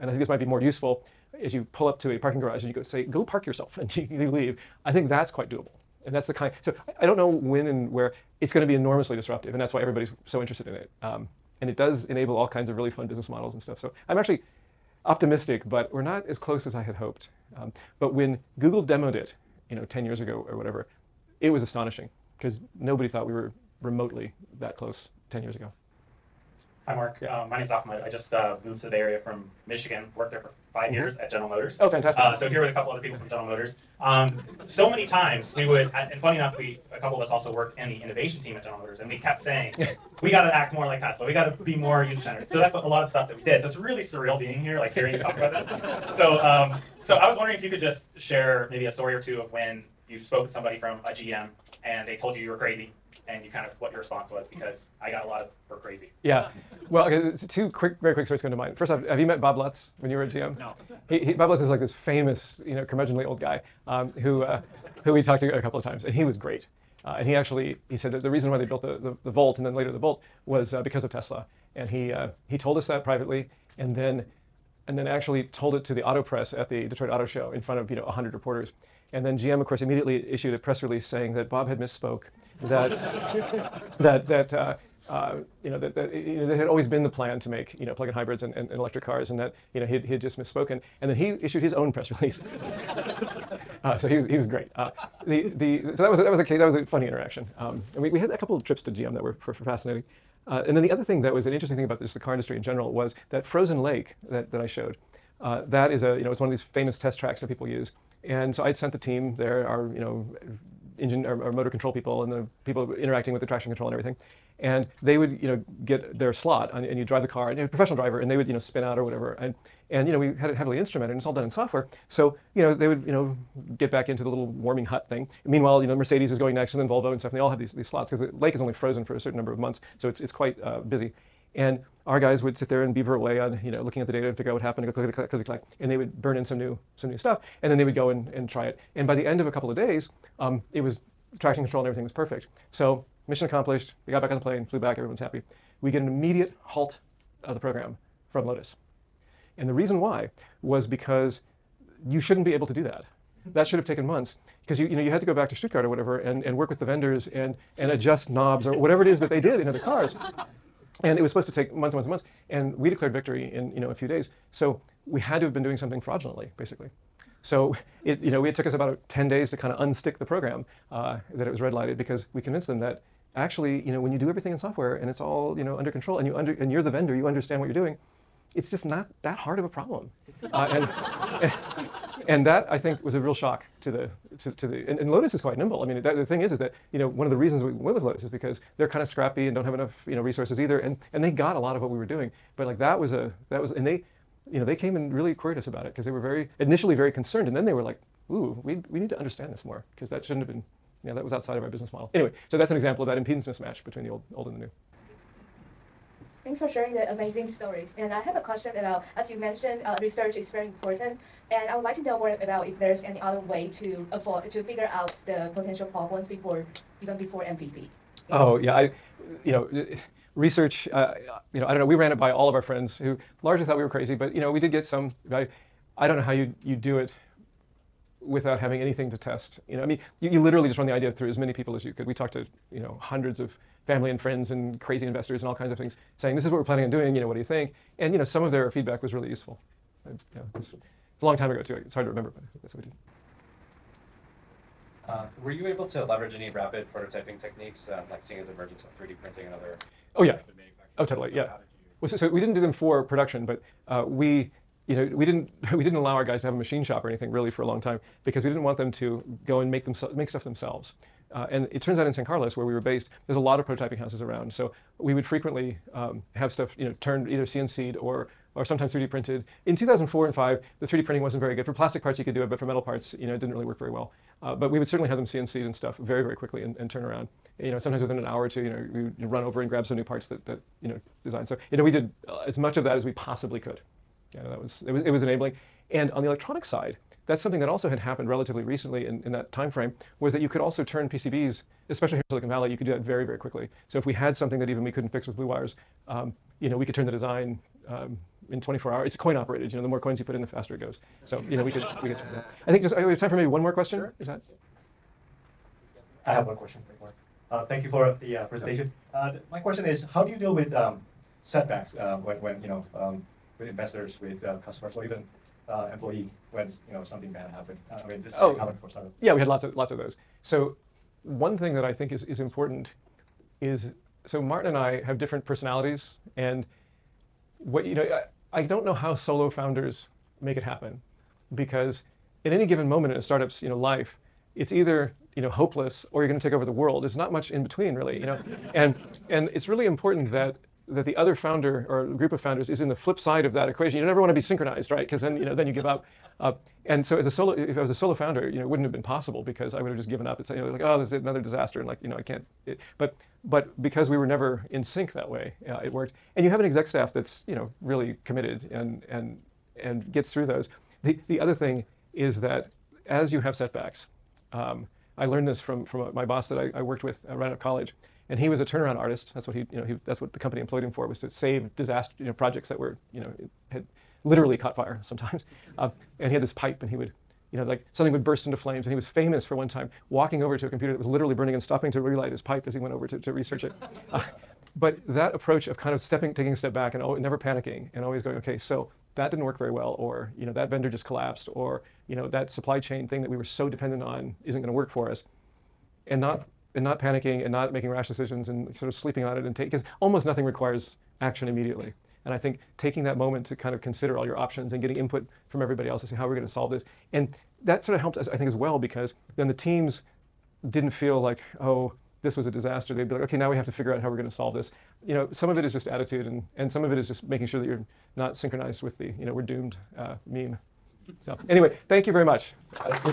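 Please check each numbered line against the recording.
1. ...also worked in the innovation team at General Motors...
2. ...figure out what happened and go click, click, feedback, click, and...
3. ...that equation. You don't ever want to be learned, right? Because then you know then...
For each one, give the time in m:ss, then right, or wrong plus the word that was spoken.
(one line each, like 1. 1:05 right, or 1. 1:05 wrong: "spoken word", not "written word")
1. 0:37 right
2. 2:14 wrong: "click", not "feedback"
3. 5:43 wrong: "synchronized", not "learned".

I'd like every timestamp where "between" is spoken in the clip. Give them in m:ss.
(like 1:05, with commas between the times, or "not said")
3:23, 5:37.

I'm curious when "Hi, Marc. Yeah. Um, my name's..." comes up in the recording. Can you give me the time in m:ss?
0:26.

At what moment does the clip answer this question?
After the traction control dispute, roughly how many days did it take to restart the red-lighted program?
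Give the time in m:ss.
2:49.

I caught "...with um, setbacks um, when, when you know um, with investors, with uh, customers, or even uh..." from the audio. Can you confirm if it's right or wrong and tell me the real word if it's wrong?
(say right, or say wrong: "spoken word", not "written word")
right.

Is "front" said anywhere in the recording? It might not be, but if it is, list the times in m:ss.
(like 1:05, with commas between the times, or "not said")
1:17.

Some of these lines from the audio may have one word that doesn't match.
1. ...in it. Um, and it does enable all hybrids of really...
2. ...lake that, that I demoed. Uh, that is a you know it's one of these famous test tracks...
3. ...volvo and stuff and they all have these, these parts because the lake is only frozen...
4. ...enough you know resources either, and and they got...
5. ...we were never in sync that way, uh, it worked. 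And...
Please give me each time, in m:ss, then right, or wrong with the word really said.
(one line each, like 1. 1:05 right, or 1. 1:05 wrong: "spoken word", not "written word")
1. 0:10 wrong: "kinds", not "hybrids"
2. 1:43 wrong: "showed", not "demoed"
3. 2:06 wrong: "slots", not "parts"
4. 3:09 right
5. 5:54 right.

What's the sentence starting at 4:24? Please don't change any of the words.
So we would frequently um, have stuff, you know, turned either CNC'd or or sometimes 3D printed.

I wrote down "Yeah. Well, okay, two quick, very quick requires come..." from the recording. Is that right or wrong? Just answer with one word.
wrong.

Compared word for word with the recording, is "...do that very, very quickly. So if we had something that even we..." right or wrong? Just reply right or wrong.
right.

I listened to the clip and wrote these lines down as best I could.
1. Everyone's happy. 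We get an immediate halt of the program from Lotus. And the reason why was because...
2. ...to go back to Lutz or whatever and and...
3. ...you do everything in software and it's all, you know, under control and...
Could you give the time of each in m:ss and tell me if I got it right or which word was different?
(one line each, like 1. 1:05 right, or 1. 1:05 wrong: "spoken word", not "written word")
1. 2:24 right
2. 2:35 wrong: "Stuttgart", not "Lutz"
3. 2:54 right.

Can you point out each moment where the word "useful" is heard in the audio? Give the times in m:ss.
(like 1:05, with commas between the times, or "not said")
0:00, 3:59.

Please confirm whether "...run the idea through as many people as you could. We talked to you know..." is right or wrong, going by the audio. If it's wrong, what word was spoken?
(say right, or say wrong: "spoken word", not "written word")
right.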